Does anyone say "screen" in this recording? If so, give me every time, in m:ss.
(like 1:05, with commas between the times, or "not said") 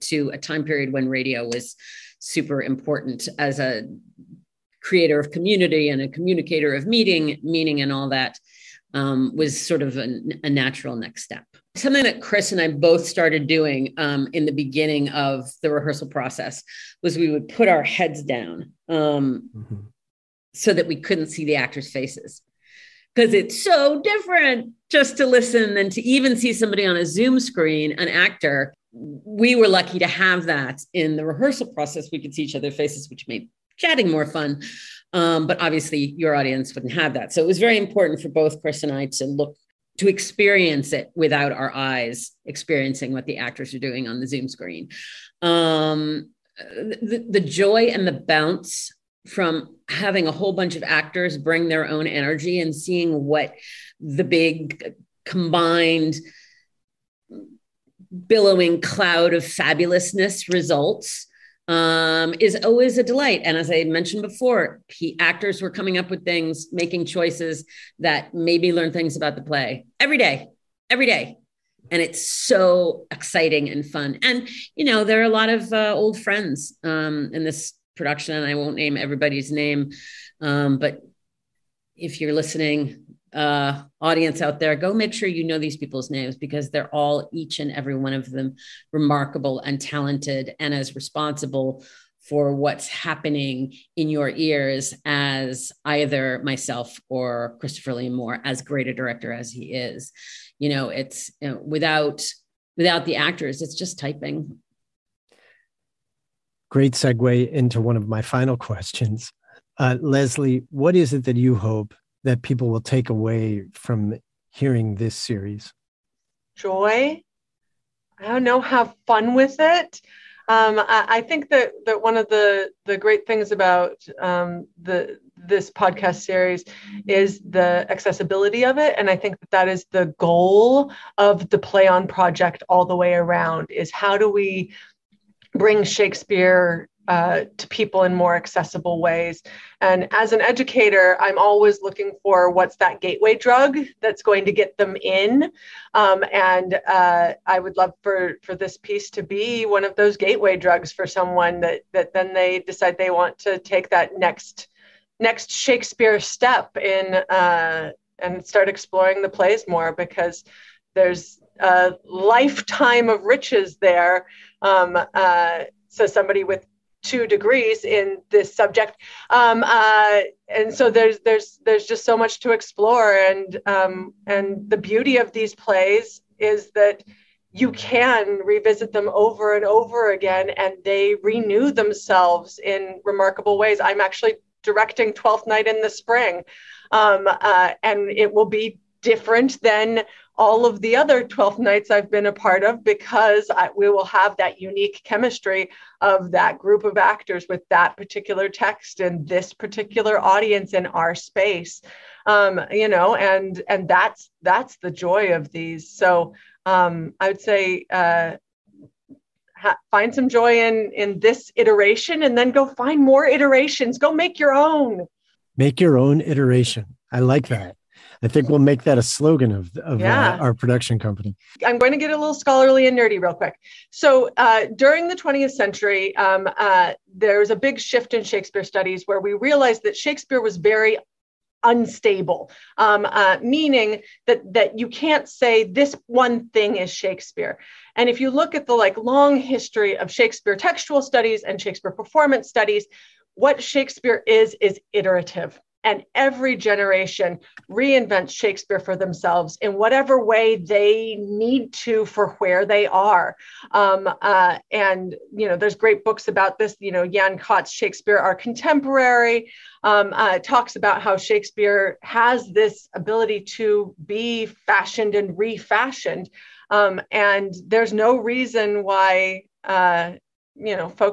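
0:27, 0:44.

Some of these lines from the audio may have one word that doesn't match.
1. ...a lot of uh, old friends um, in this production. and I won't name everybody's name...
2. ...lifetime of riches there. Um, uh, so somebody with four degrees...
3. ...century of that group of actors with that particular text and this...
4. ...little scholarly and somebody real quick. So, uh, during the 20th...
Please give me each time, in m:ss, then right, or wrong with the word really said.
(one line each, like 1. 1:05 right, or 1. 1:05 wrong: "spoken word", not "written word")
1. 1:15 right
2. 2:42 wrong: "two", not "four"
3. 3:15 wrong: "chemistry", not "century"
4. 3:42 wrong: "nerdy", not "somebody".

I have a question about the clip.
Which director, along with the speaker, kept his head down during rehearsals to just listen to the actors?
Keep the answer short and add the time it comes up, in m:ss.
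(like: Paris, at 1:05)
Christopher Liam Moore, at 1:37.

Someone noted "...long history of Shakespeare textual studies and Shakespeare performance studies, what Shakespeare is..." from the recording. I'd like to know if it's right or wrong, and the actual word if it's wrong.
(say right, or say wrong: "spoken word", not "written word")
right.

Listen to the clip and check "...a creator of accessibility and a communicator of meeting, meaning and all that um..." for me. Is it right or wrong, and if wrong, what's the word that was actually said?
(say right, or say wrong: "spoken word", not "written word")
wrong: "community", not "accessibility".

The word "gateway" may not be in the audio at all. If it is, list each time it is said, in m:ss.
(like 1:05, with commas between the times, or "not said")
2:22, 2:30.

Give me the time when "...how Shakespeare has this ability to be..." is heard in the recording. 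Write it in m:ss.
4:20.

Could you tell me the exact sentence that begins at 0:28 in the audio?
We were lucky to have that in the rehearsal process.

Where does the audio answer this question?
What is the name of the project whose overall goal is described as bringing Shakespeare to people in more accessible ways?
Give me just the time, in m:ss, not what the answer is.
2:11.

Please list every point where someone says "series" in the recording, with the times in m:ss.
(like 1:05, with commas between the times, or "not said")
1:55, 2:06.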